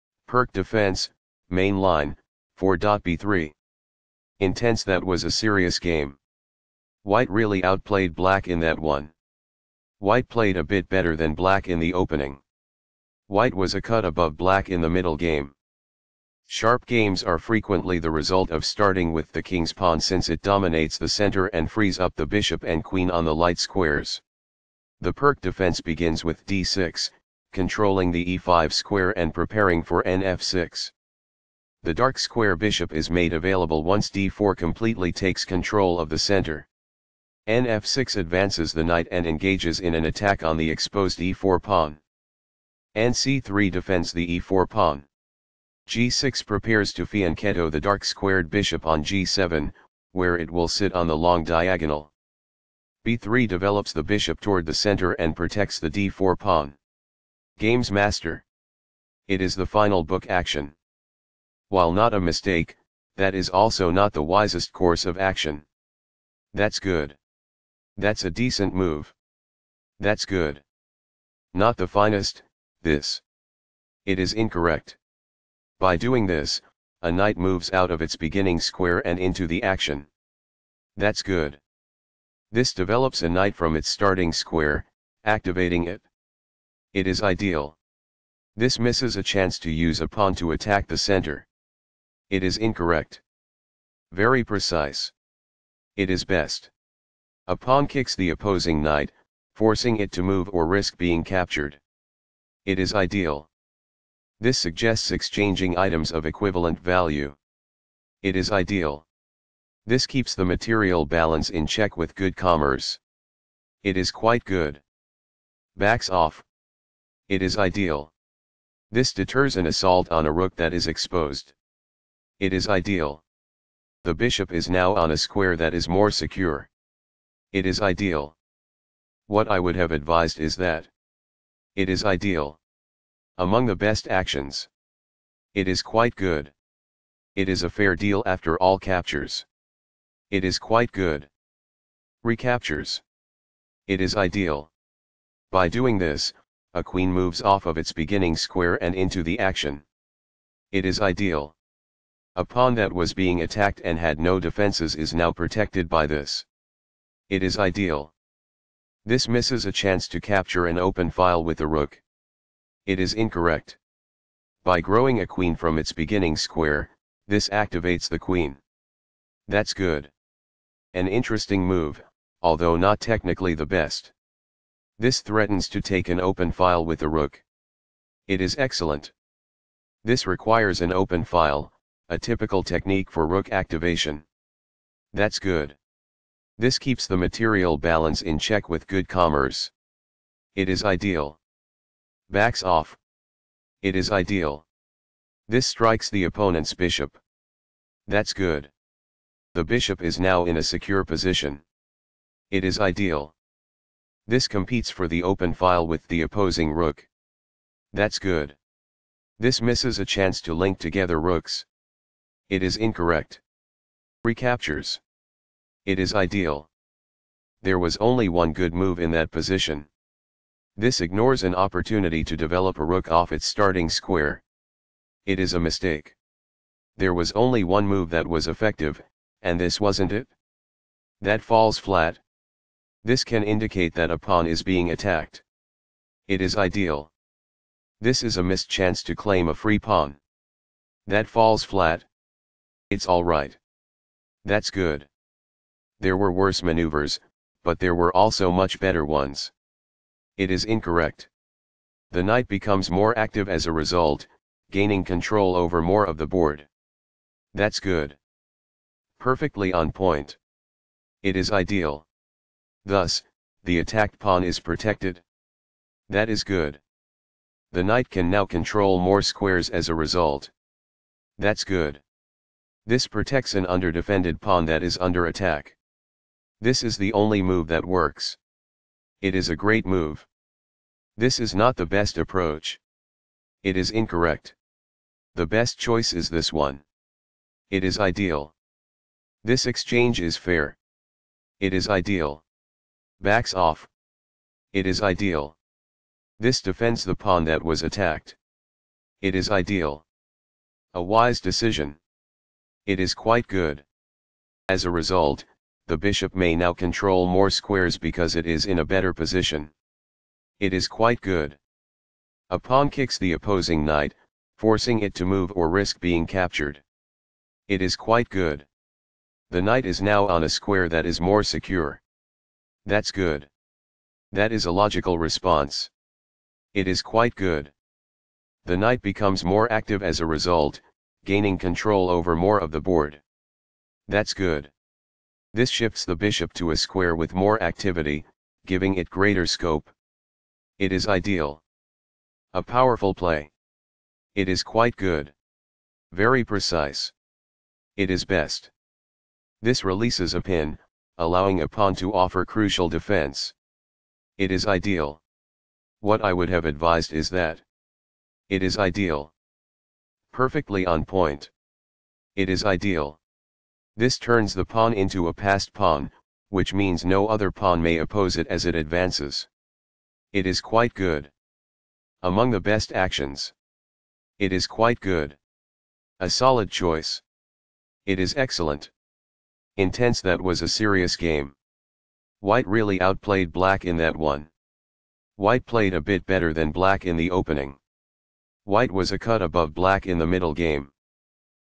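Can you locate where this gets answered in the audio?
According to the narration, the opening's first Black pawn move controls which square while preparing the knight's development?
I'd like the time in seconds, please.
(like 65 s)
28 s.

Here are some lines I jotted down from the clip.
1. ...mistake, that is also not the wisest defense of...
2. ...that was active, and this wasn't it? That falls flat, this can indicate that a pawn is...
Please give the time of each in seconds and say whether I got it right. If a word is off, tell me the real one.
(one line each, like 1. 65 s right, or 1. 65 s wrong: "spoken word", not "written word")
1. 62 s wrong: "course", not "defense"
2. 228 s wrong: "effective", not "active".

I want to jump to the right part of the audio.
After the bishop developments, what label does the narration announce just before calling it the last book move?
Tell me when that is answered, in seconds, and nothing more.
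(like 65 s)
57 s.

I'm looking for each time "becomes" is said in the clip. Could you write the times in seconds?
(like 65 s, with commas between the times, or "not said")
252 s, 329 s.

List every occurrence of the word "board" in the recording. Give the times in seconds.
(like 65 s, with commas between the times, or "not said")
256 s, 332 s.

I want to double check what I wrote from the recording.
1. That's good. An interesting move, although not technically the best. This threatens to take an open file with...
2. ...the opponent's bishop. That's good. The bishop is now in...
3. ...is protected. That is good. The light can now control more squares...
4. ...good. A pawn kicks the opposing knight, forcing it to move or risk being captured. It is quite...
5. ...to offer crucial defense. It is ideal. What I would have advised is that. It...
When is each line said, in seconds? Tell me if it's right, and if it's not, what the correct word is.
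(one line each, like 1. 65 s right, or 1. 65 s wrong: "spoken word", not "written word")
1. 169 s right
2. 196 s right
3. 264 s wrong: "knight", not "light"
4. 311 s right
5. 351 s right.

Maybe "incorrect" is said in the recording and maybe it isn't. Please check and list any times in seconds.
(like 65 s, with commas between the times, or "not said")
74 s, 92 s, 163 s, 212 s, 250 s, 283 s.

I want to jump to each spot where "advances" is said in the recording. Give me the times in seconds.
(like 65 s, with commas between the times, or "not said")
38 s, 368 s.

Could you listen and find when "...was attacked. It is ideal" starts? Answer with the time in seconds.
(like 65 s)
297 s.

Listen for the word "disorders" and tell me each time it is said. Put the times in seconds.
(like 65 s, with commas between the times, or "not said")
not said.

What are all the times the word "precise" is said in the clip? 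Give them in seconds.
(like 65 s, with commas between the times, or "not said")
94 s, 346 s.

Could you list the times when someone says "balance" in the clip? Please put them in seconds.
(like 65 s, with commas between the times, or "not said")
111 s, 187 s.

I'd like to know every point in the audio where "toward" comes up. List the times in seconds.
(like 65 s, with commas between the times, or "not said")
54 s.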